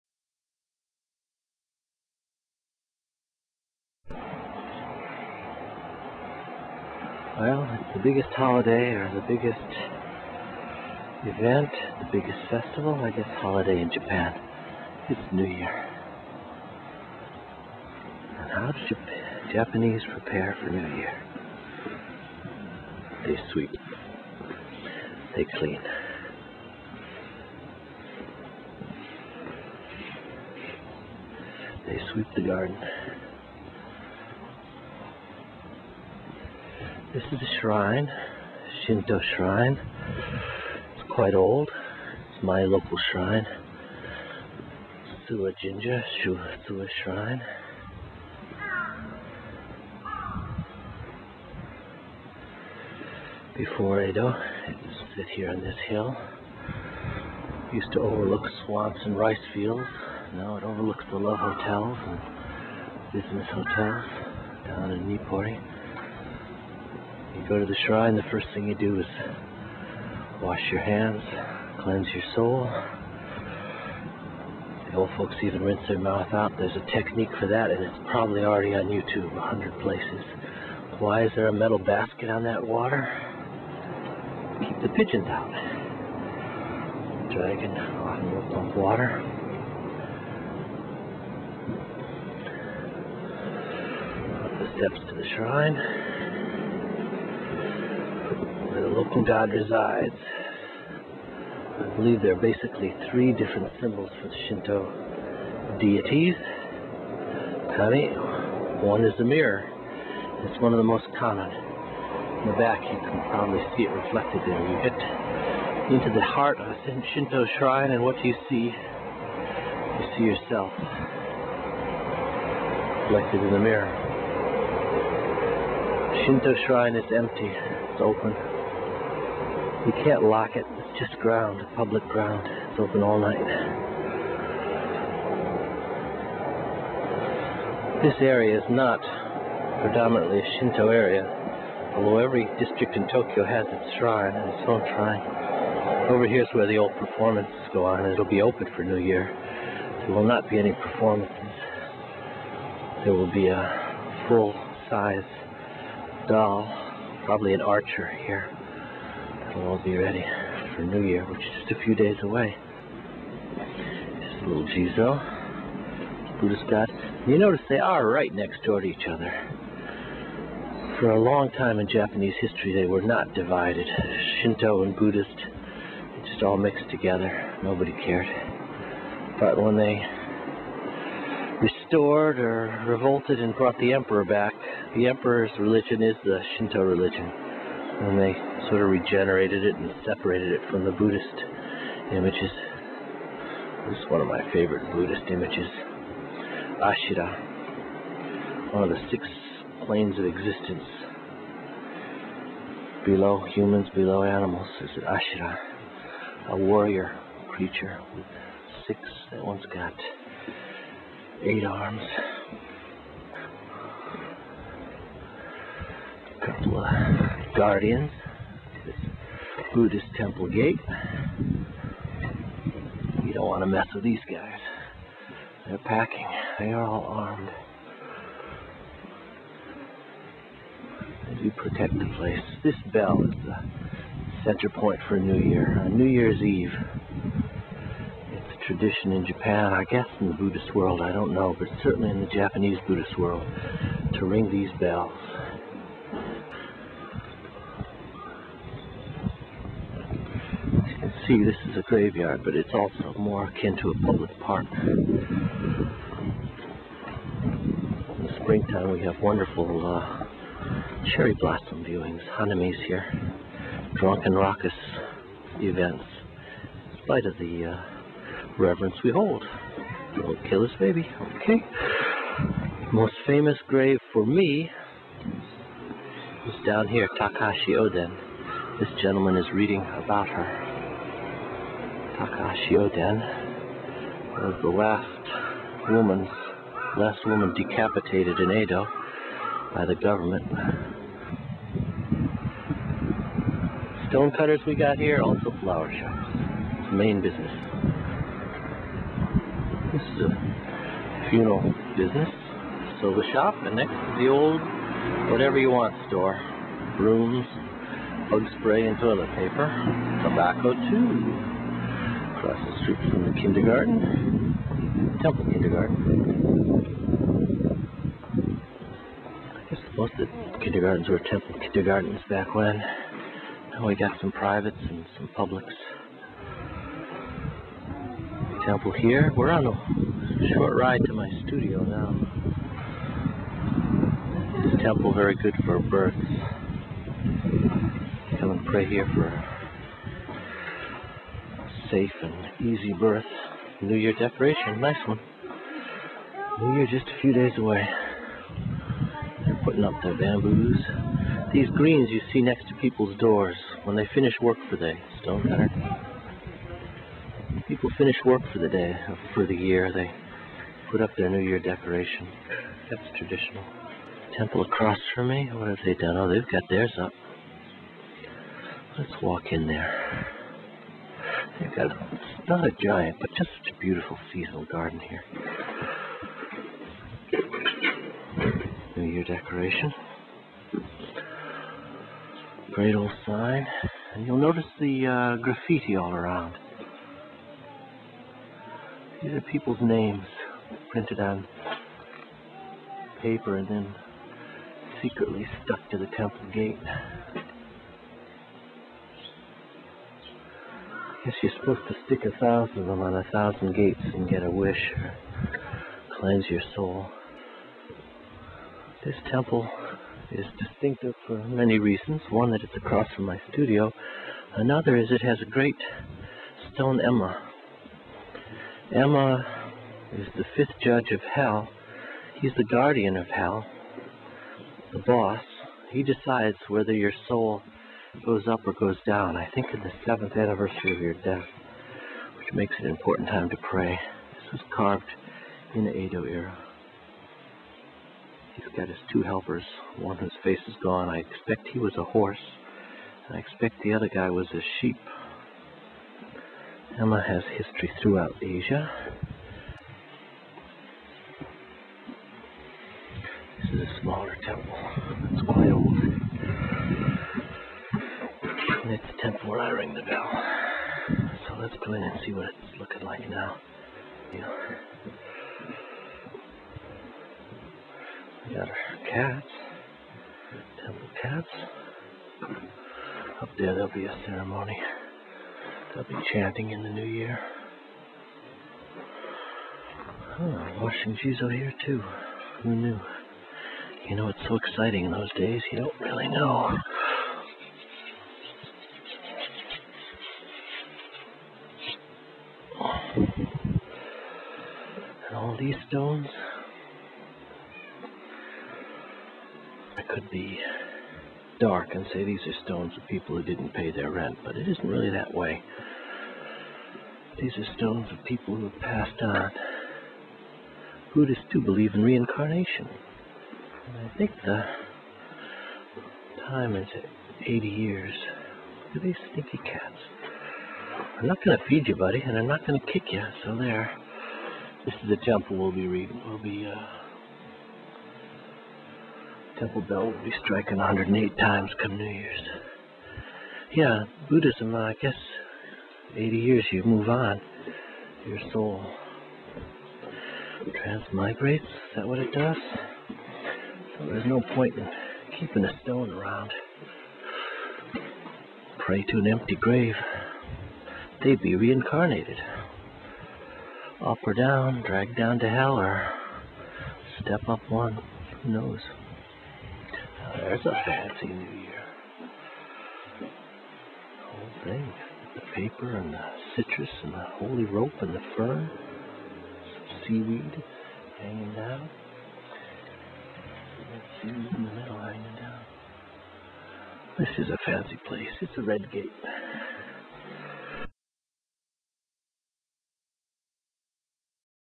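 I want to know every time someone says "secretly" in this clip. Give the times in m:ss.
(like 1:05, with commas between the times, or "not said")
6:35.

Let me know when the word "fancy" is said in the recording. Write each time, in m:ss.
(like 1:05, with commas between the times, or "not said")
9:20, 9:37.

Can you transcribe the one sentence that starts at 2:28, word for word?
It'll be open for New Year.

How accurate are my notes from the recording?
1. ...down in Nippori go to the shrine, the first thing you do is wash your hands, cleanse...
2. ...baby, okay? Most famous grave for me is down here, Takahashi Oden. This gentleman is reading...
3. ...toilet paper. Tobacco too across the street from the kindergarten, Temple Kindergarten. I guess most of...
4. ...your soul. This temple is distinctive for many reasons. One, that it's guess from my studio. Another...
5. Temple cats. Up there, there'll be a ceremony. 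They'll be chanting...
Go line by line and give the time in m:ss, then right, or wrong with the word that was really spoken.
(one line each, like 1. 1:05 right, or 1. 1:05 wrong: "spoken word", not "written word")
1. 1:04 right
2. 4:30 right
3. 5:08 right
4. 6:46 wrong: "across", not "guess"
5. 7:50 right.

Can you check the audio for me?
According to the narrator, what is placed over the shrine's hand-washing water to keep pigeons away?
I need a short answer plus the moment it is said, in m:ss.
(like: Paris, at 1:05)
A metal basket, at 1:21.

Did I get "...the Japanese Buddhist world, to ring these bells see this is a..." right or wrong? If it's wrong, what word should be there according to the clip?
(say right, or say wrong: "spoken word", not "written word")
right.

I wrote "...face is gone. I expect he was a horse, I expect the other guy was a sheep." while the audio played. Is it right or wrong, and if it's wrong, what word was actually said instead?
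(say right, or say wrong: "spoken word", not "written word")
right.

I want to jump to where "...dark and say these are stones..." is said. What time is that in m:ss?
8:21.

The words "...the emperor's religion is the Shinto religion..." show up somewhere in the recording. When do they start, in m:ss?
3:04.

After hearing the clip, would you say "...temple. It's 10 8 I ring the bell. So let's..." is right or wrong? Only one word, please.
wrong.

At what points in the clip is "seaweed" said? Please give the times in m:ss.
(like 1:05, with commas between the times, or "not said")
9:30, 9:34.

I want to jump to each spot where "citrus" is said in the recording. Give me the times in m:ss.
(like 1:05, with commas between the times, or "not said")
9:26.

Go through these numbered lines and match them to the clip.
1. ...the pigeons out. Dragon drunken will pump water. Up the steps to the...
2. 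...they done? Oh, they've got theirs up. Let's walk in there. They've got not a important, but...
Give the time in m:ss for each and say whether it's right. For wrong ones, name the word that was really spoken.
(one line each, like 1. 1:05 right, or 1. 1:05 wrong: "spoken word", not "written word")
1. 1:24 wrong: "often", not "drunken"
2. 6:05 wrong: "giant", not "important".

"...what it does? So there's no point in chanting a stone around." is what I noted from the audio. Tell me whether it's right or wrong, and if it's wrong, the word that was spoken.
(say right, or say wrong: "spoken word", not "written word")
wrong: "keeping", not "chanting".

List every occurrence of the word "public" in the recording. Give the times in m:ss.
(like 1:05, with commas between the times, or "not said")
2:11, 4:14, 5:25.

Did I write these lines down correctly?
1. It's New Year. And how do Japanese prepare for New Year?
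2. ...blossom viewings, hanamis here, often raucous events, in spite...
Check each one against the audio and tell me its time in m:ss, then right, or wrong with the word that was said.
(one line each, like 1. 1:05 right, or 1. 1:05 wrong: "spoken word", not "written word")
1. 0:15 right
2. 4:21 wrong: "drunken", not "often".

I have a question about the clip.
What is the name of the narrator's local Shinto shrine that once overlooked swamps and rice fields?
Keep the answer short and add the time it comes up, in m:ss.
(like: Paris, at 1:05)
Suwa Shrine, at 0:45.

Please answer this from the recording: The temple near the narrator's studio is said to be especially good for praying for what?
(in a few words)
Safe and easy birth.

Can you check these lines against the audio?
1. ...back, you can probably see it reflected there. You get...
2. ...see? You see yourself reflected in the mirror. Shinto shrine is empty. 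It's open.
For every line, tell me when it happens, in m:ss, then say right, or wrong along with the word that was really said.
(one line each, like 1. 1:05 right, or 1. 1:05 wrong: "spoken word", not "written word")
1. 1:52 right
2. 1:58 right.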